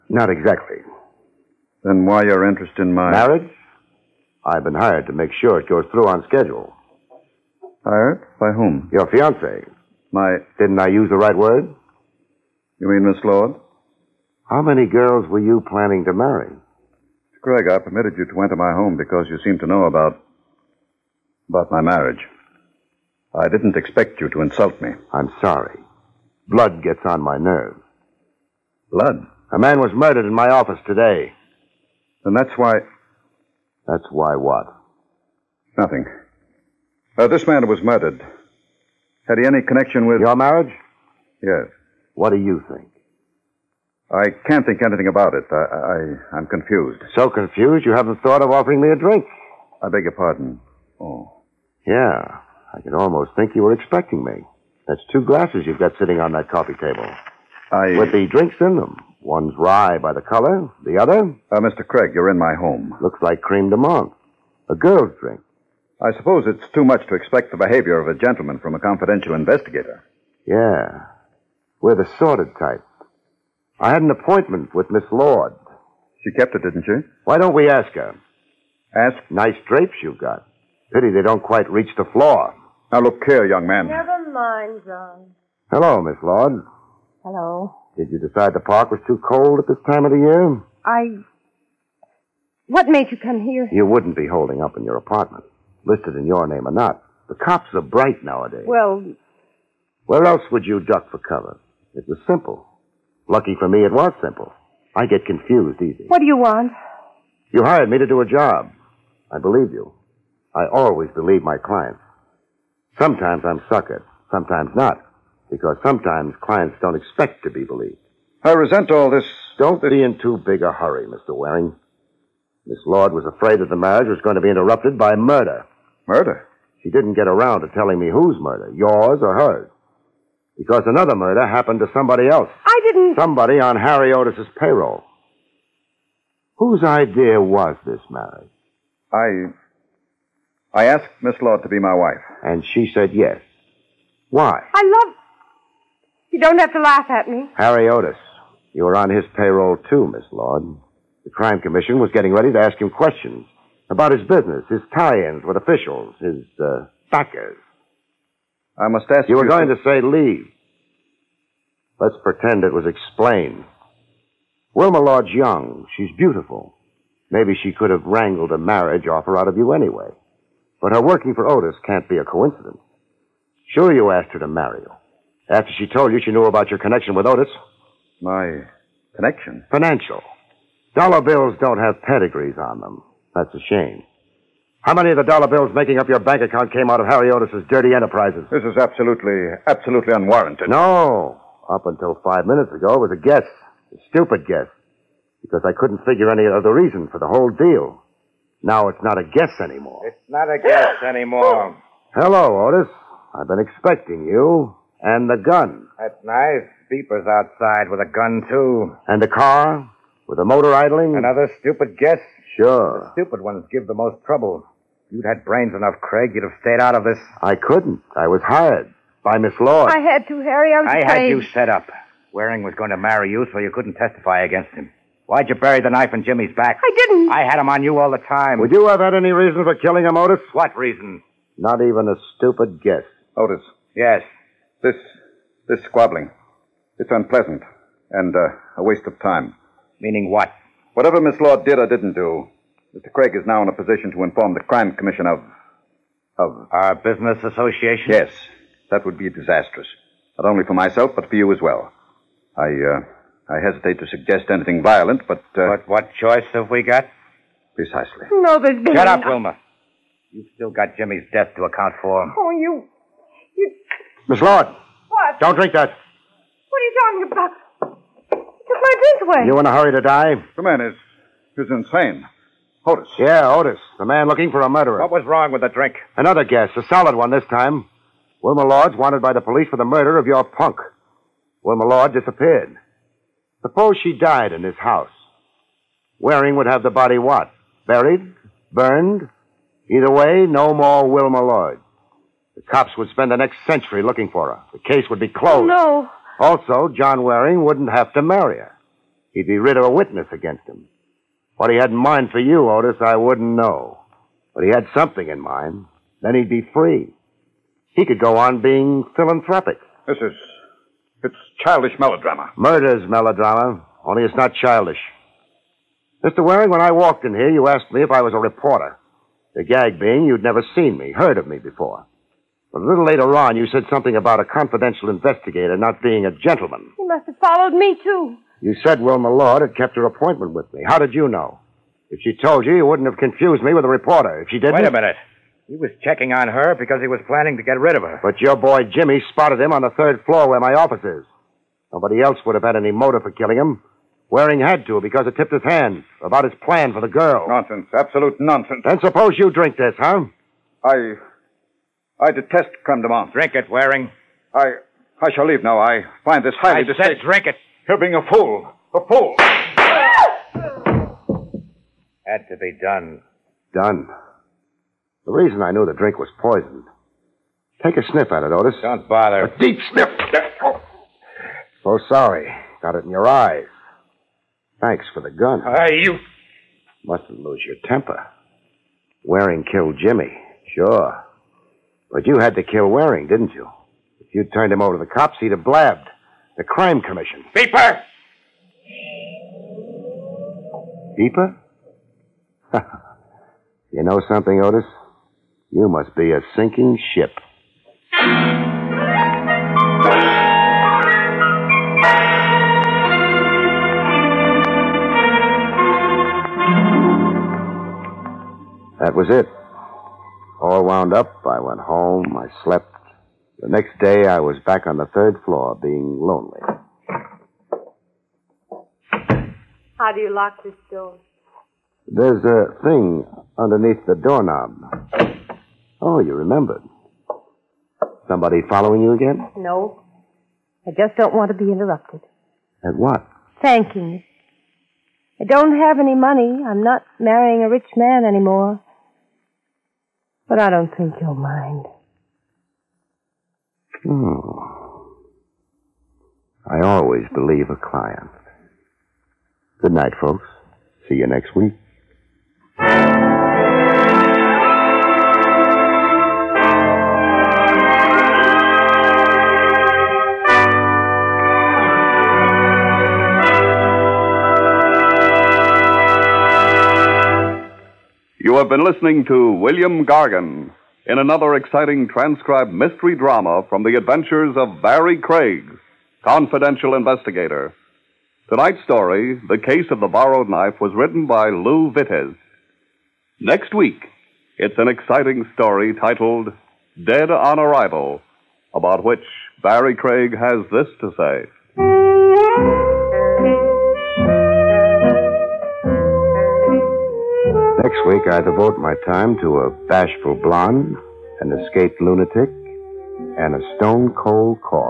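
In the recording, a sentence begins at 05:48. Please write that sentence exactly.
Then suppose you drink this, huh?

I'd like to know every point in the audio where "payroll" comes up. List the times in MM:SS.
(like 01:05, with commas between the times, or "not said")
02:14, 02:29.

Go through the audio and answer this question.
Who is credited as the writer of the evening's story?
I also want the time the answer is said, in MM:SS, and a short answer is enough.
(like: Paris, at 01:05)
Lou Vitez, at 08:01.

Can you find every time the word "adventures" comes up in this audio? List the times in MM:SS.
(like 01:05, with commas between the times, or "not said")
07:53.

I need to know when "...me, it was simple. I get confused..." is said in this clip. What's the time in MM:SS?
01:43.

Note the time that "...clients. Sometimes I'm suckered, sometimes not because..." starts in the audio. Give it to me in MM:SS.
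01:51.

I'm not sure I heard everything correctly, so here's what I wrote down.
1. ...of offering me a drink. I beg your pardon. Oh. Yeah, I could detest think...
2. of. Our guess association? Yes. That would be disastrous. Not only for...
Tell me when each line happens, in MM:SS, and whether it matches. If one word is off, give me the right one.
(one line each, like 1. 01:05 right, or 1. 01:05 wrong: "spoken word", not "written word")
1. 00:48 wrong: "almost", not "detest"
2. 04:06 wrong: "business", not "guess".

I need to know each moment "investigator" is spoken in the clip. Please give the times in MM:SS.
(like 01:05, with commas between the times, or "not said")
01:09, 05:25, 07:56.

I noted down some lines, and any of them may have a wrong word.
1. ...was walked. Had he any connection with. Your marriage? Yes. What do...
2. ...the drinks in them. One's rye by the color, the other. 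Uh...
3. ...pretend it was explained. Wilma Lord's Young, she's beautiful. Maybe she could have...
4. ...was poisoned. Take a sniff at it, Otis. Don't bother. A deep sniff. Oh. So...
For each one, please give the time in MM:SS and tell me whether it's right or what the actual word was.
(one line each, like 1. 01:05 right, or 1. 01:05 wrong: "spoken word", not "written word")
1. 00:37 wrong: "murdered", not "walked"
2. 00:58 right
3. 02:42 right
4. 06:06 right.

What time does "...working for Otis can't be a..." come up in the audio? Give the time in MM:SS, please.
02:51.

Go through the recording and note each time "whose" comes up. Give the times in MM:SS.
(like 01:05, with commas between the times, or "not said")
02:08, 02:16.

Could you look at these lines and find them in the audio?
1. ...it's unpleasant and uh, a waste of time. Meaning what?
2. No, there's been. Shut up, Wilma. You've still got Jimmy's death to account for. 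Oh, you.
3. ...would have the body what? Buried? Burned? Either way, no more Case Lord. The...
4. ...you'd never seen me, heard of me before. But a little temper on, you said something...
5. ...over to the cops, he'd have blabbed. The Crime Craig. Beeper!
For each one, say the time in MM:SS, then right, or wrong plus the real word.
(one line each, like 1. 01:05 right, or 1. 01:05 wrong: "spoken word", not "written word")
1. 03:56 right
2. 04:18 right
3. 04:46 wrong: "Wilma", not "Case"
4. 05:20 wrong: "later", not "temper"
5. 06:24 wrong: "Commission", not "Craig".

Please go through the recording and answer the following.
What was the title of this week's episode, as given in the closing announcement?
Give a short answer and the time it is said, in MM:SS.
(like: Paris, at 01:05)
The Case of the Borrowed Knife, at 07:59.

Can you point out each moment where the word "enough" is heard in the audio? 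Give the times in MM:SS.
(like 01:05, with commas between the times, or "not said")
03:35.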